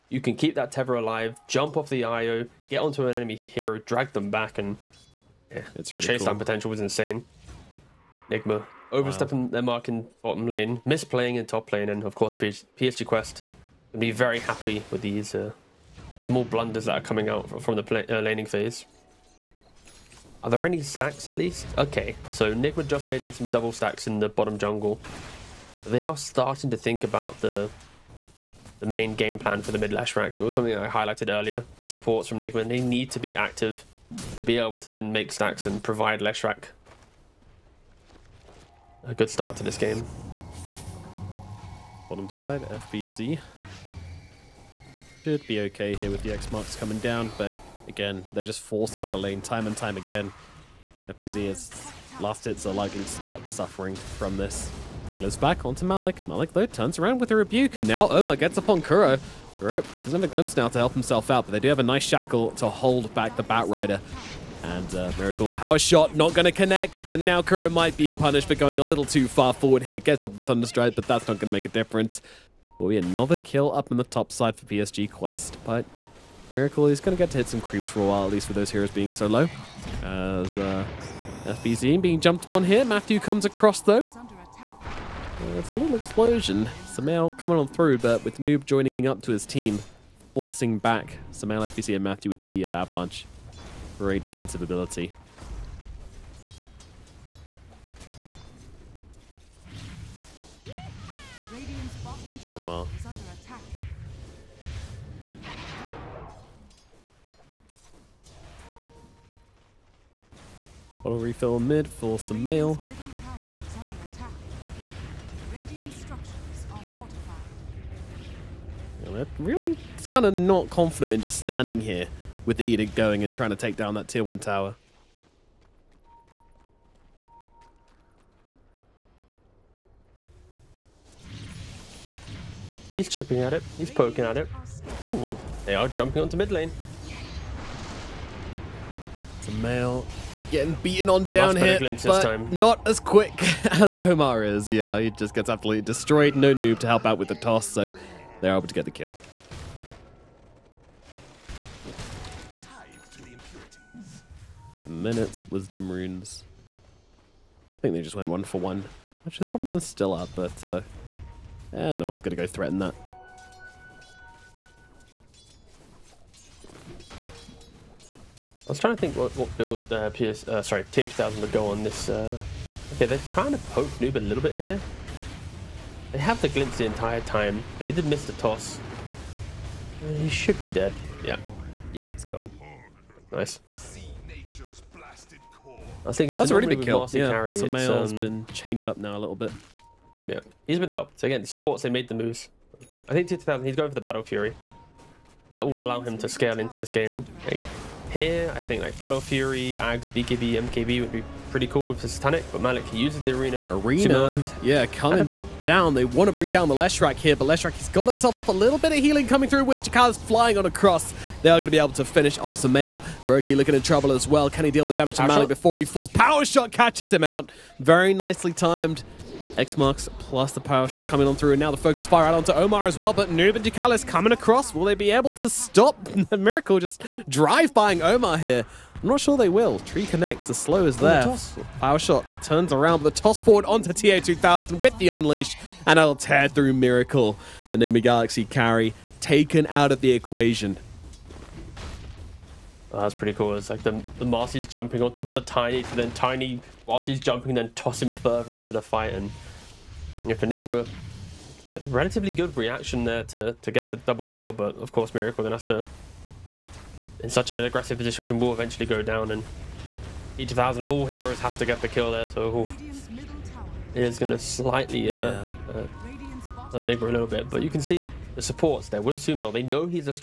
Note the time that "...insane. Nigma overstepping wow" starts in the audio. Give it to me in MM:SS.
00:06.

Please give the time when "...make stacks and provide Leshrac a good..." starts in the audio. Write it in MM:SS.
00:35.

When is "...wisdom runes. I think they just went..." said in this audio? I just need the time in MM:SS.
02:35.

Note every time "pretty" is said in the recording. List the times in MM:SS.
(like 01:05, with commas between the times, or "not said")
03:21, 04:03.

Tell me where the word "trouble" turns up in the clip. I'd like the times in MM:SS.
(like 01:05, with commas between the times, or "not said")
03:33.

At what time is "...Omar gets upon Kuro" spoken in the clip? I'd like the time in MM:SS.
00:58.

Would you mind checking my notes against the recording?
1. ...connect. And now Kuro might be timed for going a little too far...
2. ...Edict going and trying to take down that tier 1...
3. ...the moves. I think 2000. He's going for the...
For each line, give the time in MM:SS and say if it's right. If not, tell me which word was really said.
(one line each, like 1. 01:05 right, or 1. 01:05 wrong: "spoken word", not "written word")
1. 01:06 wrong: "punished", not "timed"
2. 02:02 right
3. 03:12 right.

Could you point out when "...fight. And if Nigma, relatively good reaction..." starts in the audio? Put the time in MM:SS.
04:08.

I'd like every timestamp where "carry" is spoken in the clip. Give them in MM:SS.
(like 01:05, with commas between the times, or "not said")
03:07, 03:58.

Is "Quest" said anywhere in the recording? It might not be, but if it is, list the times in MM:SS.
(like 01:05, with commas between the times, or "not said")
00:13, 01:15.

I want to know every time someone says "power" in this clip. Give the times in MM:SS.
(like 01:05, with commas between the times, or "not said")
01:05, 03:36, 03:40, 03:51.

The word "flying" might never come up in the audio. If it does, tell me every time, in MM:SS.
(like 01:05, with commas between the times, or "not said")
03:30.